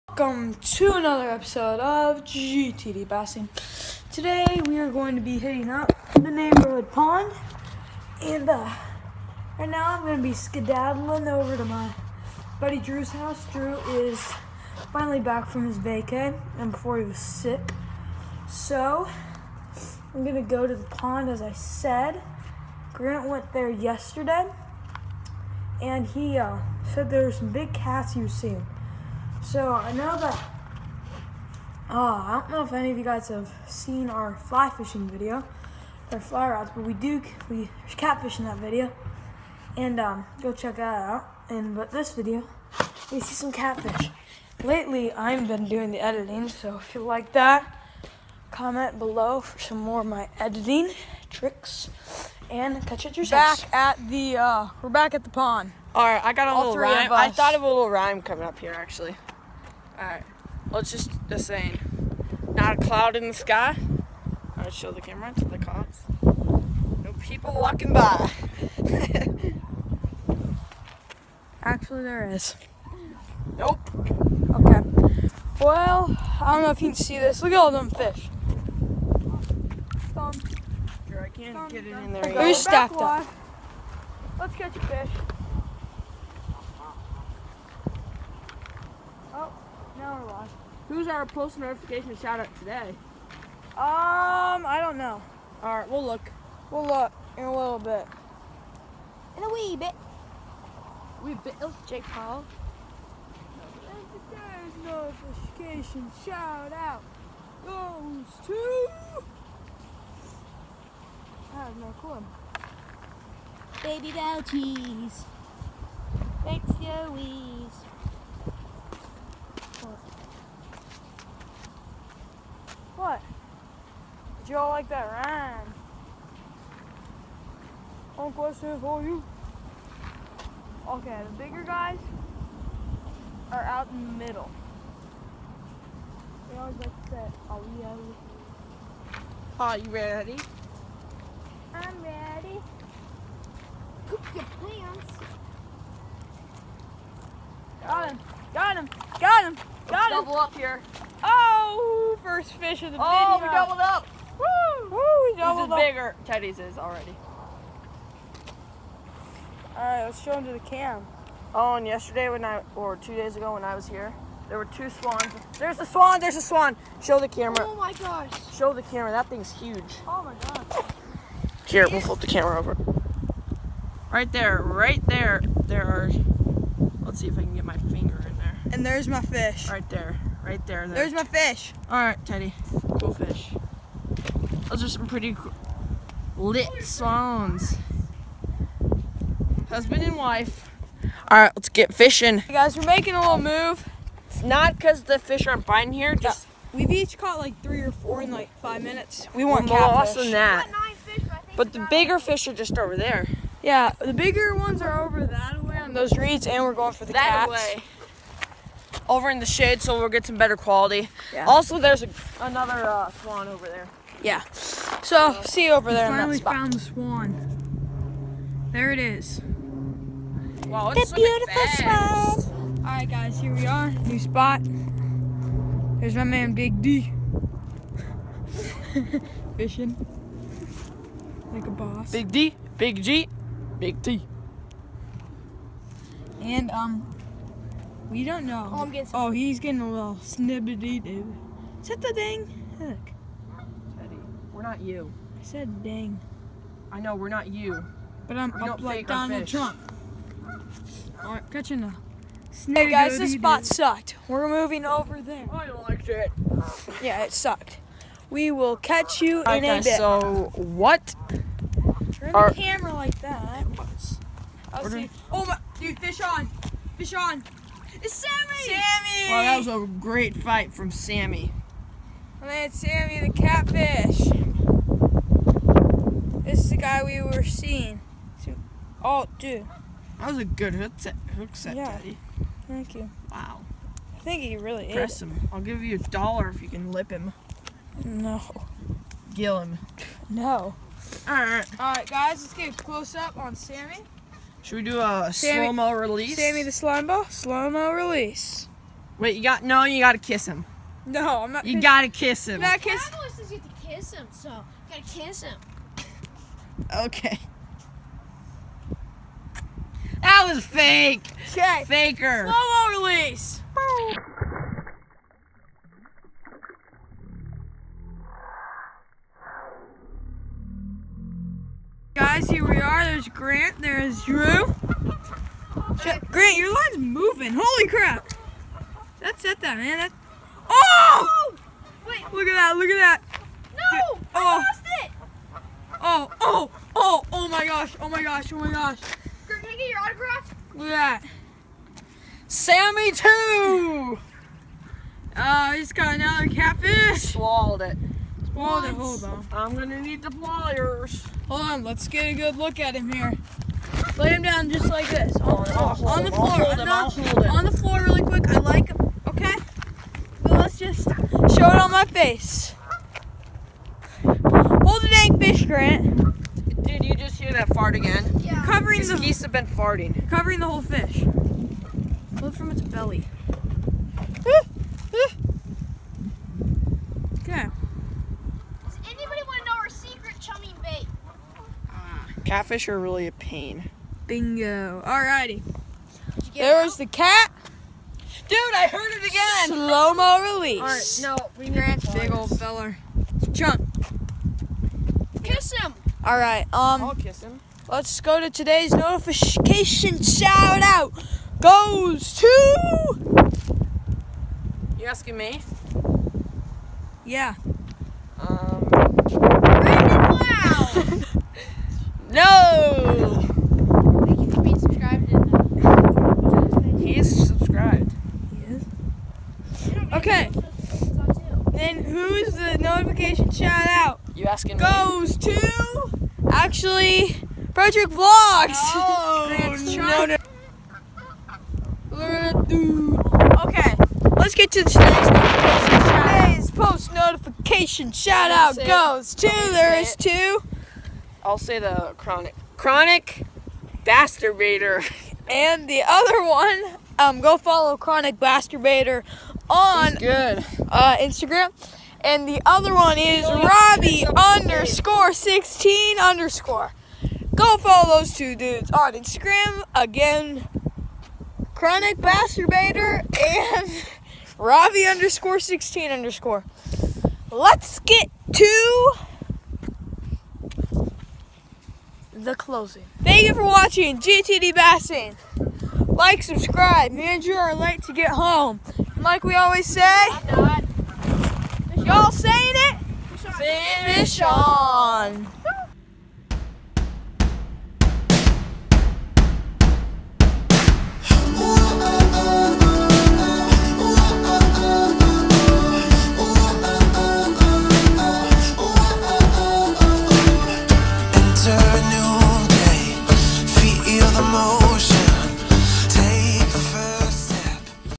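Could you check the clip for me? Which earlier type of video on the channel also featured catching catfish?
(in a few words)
fly fishing.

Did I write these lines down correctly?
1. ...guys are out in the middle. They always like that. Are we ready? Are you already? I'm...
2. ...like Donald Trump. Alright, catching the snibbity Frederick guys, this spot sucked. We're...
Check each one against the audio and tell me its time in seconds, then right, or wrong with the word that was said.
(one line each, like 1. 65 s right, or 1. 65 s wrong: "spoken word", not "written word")
1. 131 s wrong: "ready", not "already"
2. 248 s wrong: "Hey", not "Frederick".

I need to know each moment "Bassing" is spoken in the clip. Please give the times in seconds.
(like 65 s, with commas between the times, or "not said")
3 s, 474 s.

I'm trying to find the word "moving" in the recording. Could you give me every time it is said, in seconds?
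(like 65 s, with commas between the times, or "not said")
254 s, 326 s.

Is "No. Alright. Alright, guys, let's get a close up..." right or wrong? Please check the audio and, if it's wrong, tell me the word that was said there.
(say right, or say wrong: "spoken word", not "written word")
right.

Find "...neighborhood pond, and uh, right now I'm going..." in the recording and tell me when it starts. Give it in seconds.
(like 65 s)
6 s.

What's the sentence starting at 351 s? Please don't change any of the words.
Hold on, let's get a good look at him here.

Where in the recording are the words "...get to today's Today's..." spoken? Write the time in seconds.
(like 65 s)
434 s.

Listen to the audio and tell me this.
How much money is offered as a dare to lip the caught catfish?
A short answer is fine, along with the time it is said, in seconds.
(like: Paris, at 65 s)
a dollar, at 286 s.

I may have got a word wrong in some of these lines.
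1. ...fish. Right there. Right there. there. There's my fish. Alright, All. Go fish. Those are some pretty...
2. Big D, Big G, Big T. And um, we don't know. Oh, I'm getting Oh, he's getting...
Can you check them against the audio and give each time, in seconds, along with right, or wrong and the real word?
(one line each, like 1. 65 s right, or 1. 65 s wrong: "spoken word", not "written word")
1. 179 s wrong: "Teddy", not "All"
2. 232 s right.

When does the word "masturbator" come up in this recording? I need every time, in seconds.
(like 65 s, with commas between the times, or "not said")
444 s, 448 s, 462 s.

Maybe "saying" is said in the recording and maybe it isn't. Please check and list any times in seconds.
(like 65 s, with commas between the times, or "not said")
61 s, 482 s.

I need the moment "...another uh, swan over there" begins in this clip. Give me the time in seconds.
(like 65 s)
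212 s.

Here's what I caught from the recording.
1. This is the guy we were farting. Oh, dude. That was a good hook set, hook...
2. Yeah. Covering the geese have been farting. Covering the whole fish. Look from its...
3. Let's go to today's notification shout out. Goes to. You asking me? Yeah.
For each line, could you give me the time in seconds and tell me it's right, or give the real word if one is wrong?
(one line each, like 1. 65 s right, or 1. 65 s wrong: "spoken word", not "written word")
1. 276 s wrong: "seeing", not "farting"
2. 368 s right
3. 397 s right.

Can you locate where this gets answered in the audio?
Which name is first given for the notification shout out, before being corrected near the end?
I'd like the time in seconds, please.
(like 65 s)
427 s.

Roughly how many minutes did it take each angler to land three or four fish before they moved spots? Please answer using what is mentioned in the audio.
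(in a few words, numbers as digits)
5.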